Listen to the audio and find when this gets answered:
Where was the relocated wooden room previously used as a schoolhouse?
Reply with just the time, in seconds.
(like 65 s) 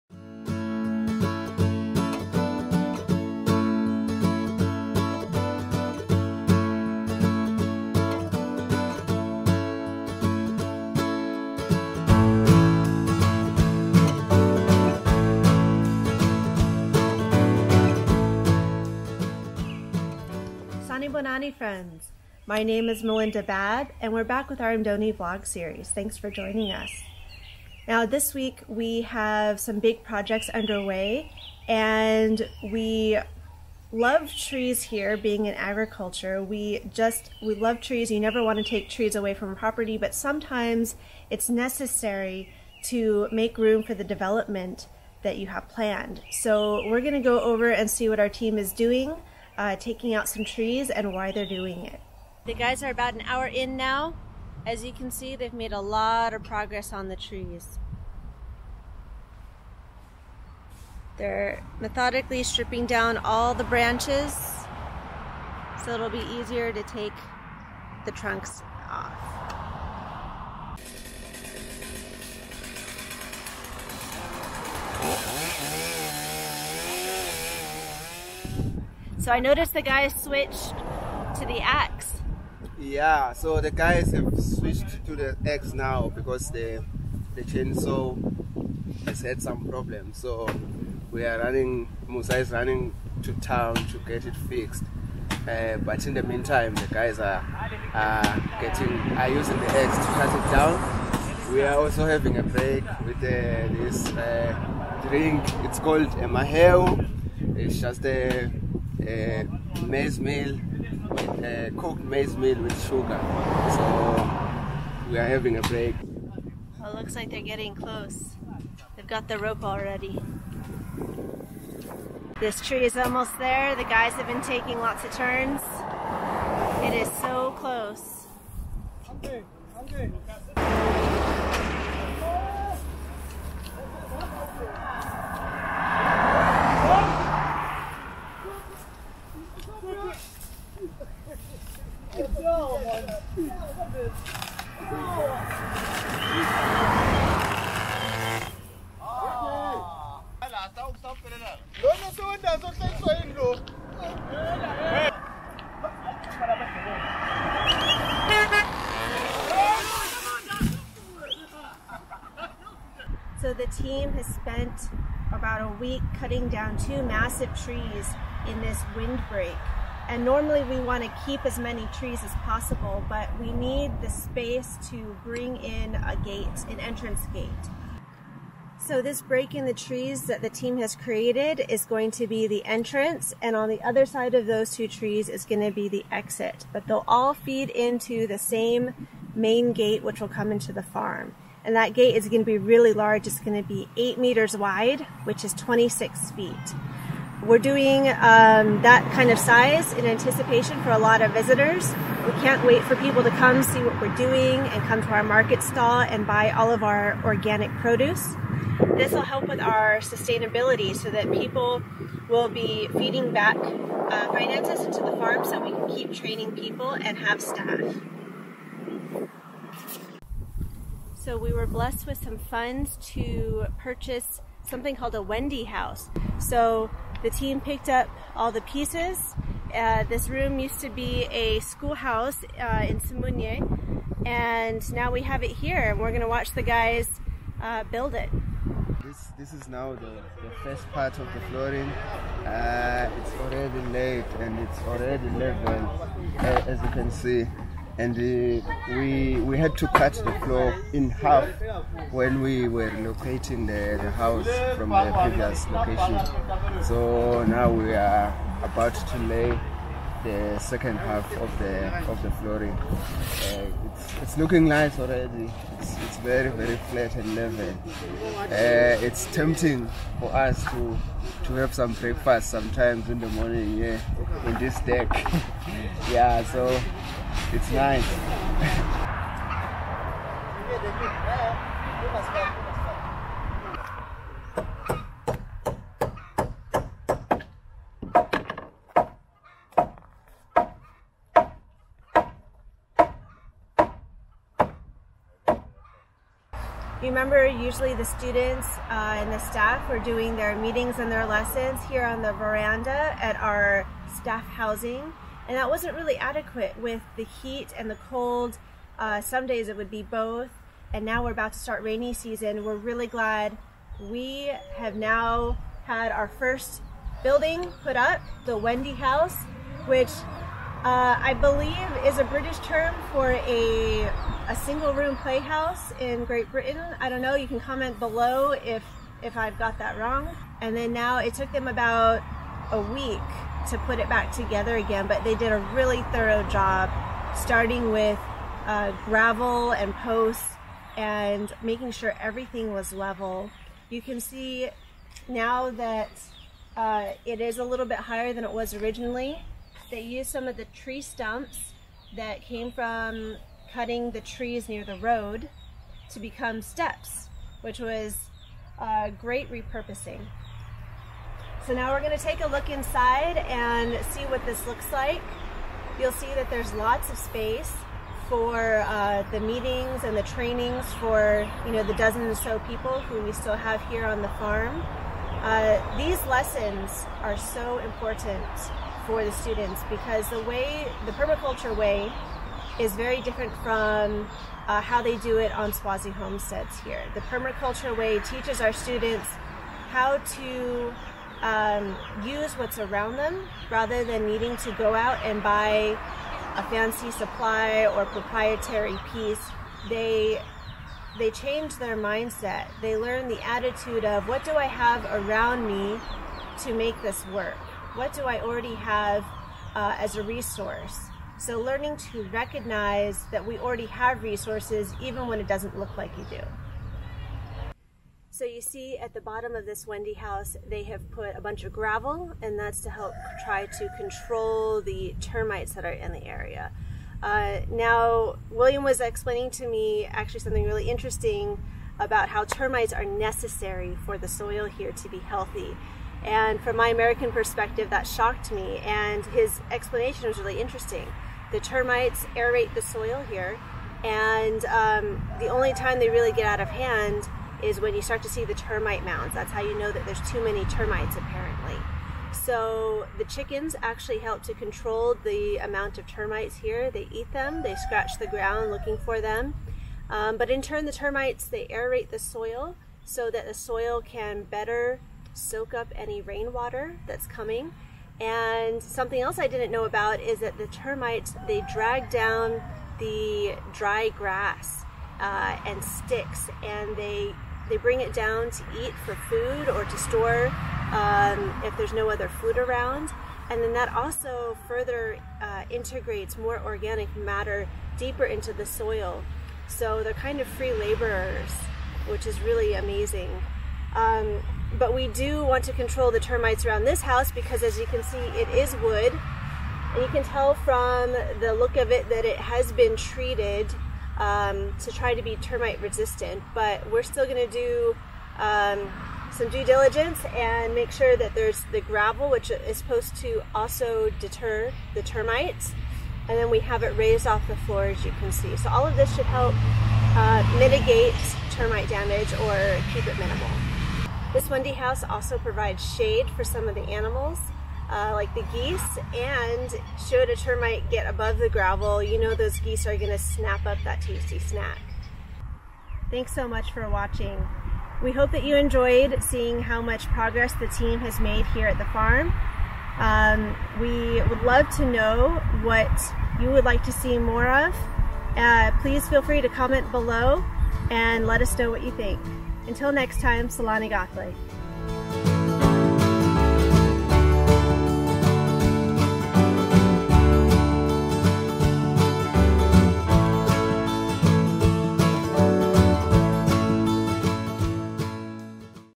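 232 s.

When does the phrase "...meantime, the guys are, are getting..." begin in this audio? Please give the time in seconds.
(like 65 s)
96 s.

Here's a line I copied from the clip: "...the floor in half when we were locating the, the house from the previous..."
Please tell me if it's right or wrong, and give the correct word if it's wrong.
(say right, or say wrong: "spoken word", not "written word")
right.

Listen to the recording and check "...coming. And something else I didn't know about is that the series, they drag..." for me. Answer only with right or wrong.
wrong.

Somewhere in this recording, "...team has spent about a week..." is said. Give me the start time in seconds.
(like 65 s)
163 s.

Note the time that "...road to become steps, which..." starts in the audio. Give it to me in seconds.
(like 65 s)
354 s.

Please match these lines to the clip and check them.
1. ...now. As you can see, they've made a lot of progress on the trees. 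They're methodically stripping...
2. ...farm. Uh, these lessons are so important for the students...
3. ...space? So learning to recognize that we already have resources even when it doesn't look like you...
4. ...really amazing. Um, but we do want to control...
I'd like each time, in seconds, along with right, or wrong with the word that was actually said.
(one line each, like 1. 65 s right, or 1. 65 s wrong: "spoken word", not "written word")
1. 53 s right
2. 374 s right
3. 410 s wrong: "resource", not "space"
4. 492 s right.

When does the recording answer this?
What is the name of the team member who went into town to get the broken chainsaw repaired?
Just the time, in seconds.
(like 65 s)
92 s.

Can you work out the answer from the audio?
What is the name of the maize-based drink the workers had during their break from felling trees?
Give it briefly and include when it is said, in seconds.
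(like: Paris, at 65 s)
maheu, at 106 s.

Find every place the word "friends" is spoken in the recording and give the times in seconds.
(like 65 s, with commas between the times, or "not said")
21 s.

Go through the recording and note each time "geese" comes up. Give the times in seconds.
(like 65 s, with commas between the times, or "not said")
528 s, 532 s.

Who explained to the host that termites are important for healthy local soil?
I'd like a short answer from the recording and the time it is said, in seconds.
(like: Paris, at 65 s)
William, at 428 s.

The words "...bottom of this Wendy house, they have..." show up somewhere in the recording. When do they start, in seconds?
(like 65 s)
419 s.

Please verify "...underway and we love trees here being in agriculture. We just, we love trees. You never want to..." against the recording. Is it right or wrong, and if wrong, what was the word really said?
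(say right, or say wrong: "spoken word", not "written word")
right.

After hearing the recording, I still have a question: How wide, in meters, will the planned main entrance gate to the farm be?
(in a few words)
8 meters.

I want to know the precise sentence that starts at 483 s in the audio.
And then that also further uh, integrates more organic matter deeper into the soil.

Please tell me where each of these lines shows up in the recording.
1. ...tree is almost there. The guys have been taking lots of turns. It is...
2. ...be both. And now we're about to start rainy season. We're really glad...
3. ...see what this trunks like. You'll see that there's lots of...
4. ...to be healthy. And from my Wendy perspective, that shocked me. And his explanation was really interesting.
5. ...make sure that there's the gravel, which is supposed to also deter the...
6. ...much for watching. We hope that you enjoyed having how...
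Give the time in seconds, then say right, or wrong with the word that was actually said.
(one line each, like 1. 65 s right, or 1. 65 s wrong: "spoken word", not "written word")
1. 122 s right
2. 309 s right
3. 364 s wrong: "looks", not "trunks"
4. 434 s wrong: "American", not "Wendy"
5. 510 s right
6. 536 s wrong: "seeing", not "having".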